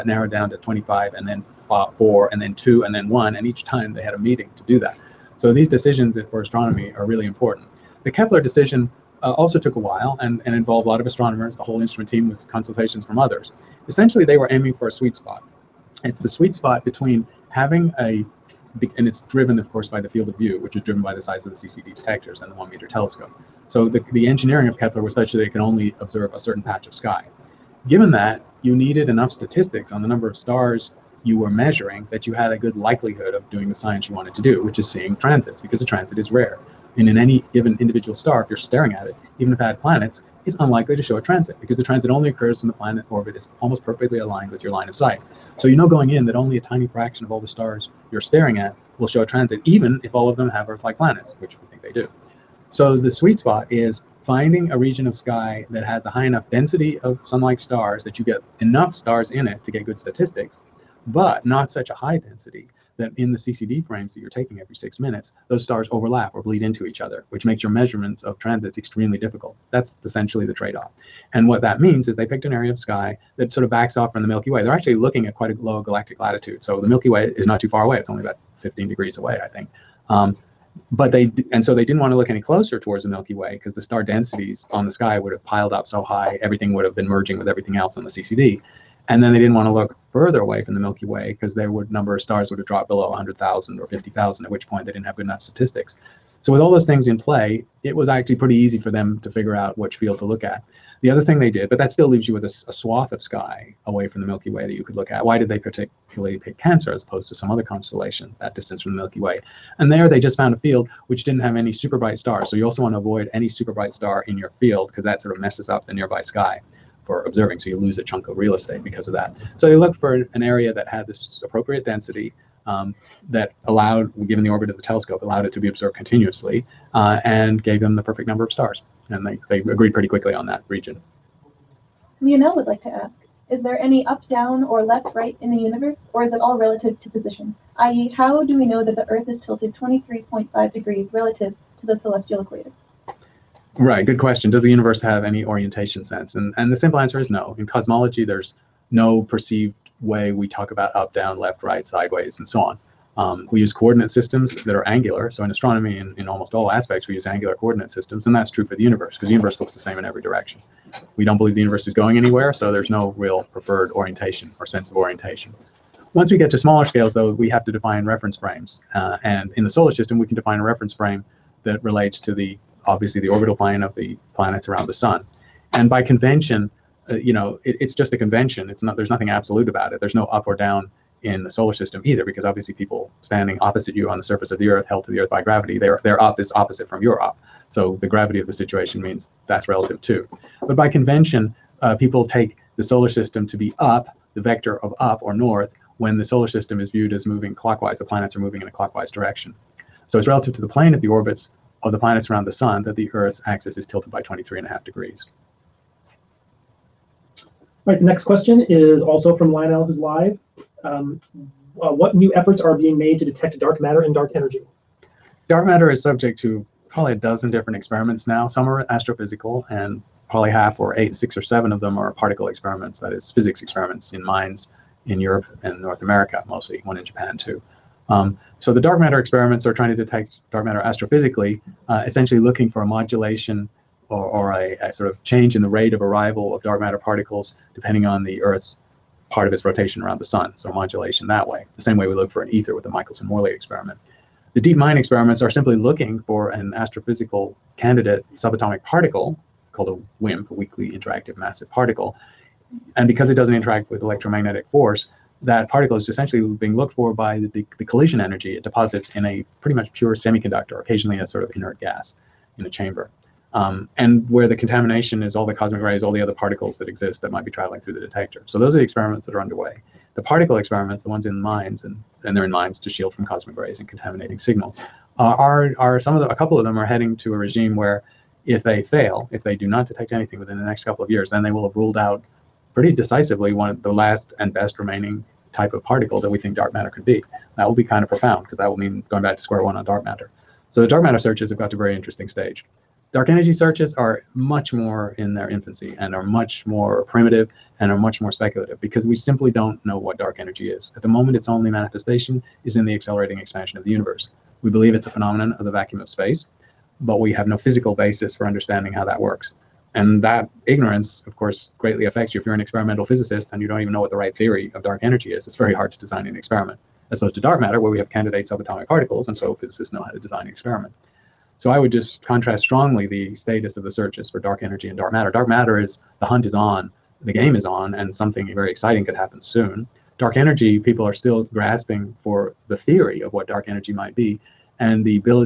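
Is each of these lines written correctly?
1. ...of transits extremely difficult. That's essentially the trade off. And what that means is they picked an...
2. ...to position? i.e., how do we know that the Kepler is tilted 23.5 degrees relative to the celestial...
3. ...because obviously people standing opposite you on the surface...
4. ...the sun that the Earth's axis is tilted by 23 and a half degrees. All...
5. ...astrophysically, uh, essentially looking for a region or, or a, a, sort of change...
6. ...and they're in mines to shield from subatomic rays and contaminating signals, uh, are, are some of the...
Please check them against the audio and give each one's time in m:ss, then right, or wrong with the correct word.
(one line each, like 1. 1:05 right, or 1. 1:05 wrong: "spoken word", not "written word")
1. 1:08 right
2. 2:17 wrong: "Earth", not "Kepler"
3. 3:02 right
4. 3:22 right
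5. 3:50 wrong: "modulation", not "region"
6. 4:32 wrong: "cosmic", not "subatomic".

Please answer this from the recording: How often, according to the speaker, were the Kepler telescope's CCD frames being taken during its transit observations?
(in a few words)
every 6 minutes.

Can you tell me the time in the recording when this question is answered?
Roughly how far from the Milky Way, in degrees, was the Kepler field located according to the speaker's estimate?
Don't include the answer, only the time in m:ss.
1:18.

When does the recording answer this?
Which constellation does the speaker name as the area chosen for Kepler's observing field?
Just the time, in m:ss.
1:46.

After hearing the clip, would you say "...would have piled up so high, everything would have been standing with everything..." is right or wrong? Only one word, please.
wrong.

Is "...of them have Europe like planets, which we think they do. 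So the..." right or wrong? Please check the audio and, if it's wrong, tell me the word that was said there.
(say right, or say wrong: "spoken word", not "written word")
wrong: "Earth", not "Europe".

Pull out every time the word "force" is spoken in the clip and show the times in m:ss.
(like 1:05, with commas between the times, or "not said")
4:14.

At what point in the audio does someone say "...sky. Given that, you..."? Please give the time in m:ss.
0:26.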